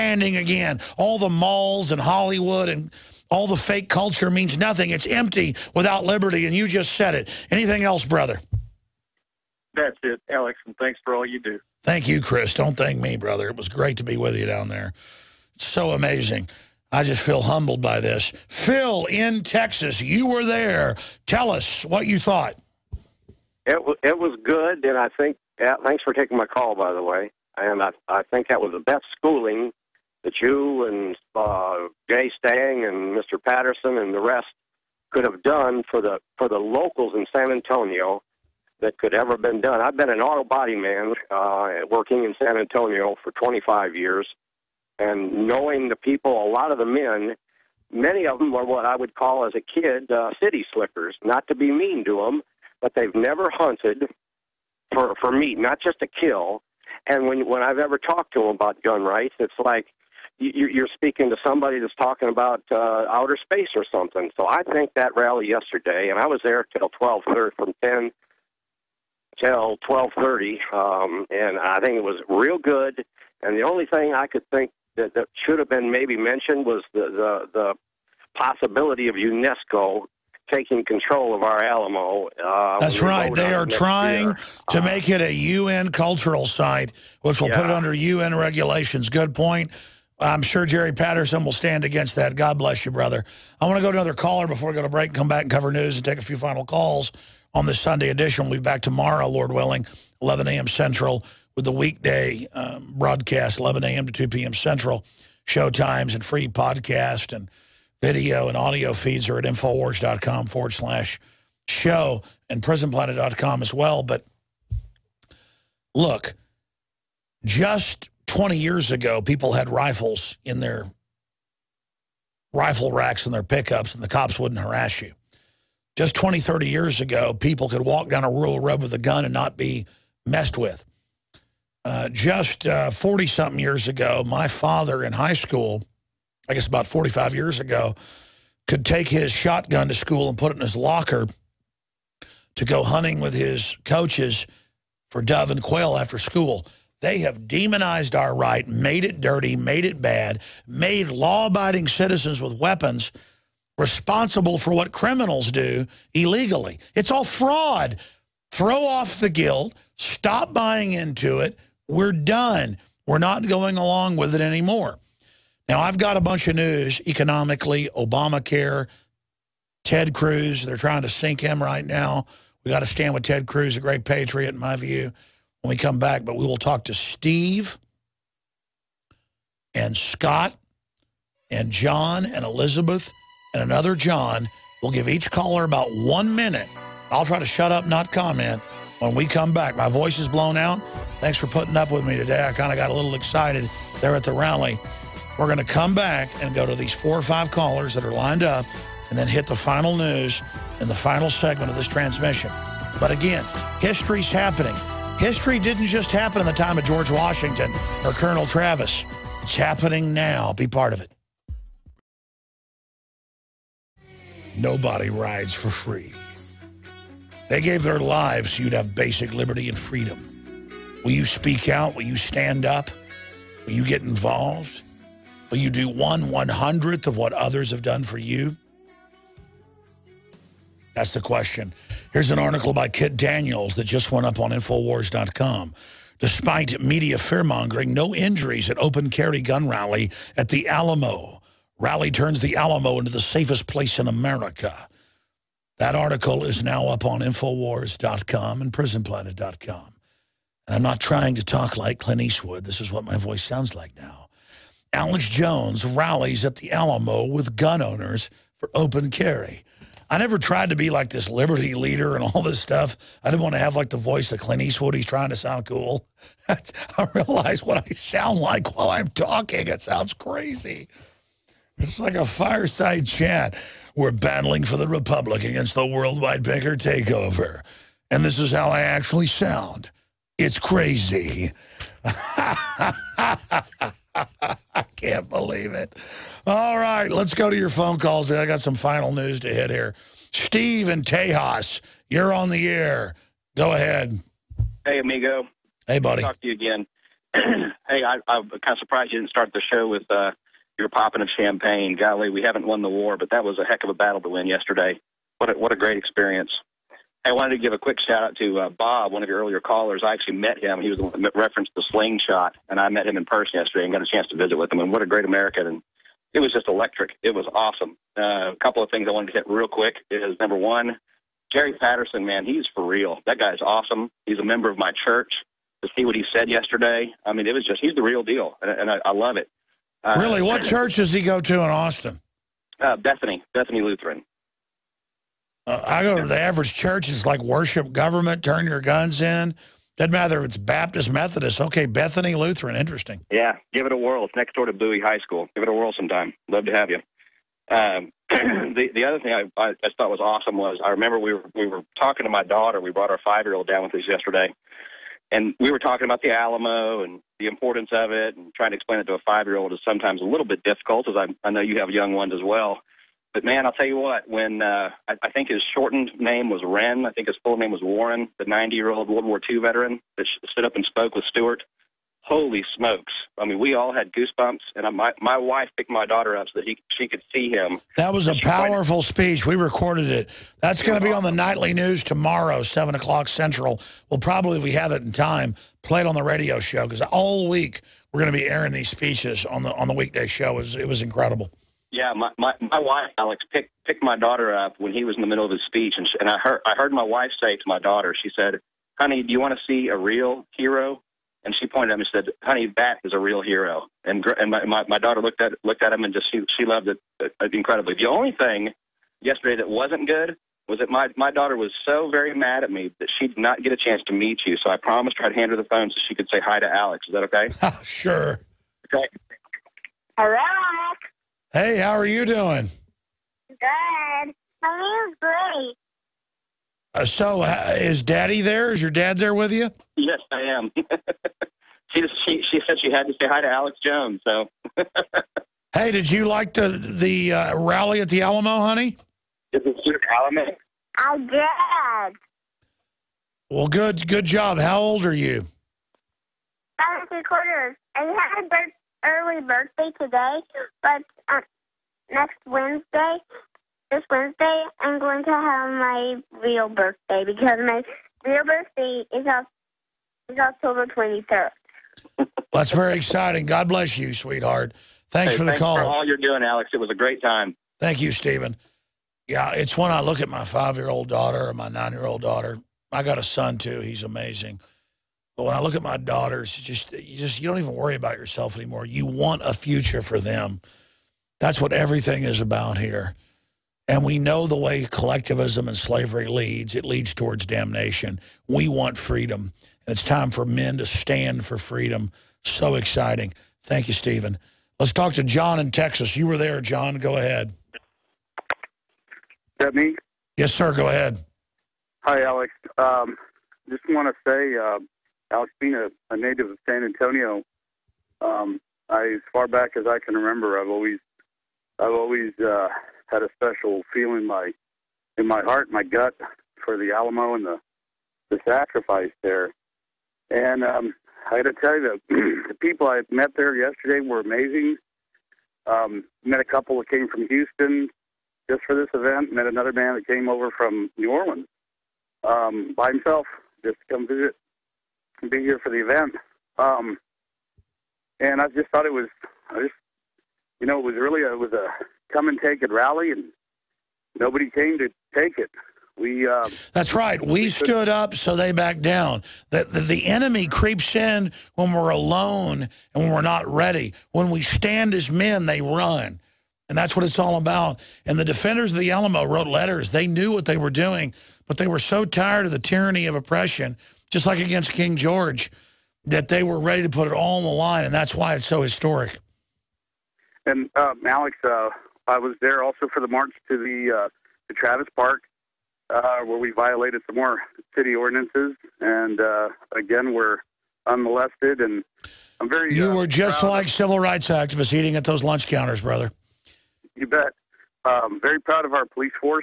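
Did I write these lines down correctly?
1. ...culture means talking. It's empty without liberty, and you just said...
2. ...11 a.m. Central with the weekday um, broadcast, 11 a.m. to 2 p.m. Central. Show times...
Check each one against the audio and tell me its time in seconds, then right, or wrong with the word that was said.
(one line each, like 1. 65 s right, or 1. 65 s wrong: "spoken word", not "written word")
1. 3 s wrong: "nothing", not "talking"
2. 100 s right.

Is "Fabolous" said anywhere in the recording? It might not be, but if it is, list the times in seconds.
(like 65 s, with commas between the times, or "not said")
not said.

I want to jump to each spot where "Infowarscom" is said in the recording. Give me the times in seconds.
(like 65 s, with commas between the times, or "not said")
109 s, 234 s, 247 s.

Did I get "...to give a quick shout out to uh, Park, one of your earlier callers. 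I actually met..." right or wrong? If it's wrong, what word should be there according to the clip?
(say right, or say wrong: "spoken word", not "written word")
wrong: "Bob", not "Park".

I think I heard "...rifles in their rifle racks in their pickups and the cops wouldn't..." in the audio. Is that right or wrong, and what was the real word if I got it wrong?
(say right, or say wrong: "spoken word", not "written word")
right.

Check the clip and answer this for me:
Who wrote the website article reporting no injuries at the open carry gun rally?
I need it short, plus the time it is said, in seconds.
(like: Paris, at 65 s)
Kit Daniels, at 232 s.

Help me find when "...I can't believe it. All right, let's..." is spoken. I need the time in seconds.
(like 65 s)
284 s.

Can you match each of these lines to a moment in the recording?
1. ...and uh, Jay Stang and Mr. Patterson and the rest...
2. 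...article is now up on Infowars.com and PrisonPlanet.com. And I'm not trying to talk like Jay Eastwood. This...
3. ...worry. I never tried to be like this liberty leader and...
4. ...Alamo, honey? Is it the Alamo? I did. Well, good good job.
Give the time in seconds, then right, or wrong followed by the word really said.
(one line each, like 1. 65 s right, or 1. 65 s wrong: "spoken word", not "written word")
1. 30 s right
2. 245 s wrong: "Clint", not "Jay"
3. 259 s wrong: "carry", not "worry"
4. 438 s right.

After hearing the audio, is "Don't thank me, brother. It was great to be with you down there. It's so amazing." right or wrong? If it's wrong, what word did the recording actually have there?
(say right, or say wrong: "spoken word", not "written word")
right.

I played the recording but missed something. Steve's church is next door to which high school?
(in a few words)
Bowie High School.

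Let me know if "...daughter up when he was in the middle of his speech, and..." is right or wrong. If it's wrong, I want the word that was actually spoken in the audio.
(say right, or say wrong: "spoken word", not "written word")
right.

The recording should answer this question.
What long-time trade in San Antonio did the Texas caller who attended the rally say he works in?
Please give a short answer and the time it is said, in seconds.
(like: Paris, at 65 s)
Auto body man, at 40 s.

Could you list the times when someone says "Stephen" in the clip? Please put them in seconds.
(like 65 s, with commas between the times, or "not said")
468 s, 493 s.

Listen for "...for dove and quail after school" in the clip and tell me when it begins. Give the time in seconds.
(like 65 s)
145 s.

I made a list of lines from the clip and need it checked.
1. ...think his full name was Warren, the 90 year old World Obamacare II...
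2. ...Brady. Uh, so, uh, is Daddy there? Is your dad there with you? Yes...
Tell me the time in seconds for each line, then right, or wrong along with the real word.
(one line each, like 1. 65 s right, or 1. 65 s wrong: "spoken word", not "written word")
1. 367 s wrong: "War", not "Obamacare"
2. 425 s right.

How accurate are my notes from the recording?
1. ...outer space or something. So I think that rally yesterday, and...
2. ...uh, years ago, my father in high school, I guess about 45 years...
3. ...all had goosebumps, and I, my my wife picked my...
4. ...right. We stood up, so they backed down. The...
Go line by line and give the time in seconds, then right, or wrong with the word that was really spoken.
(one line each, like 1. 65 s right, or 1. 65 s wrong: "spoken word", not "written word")
1. 63 s right
2. 133 s right
3. 373 s right
4. 546 s right.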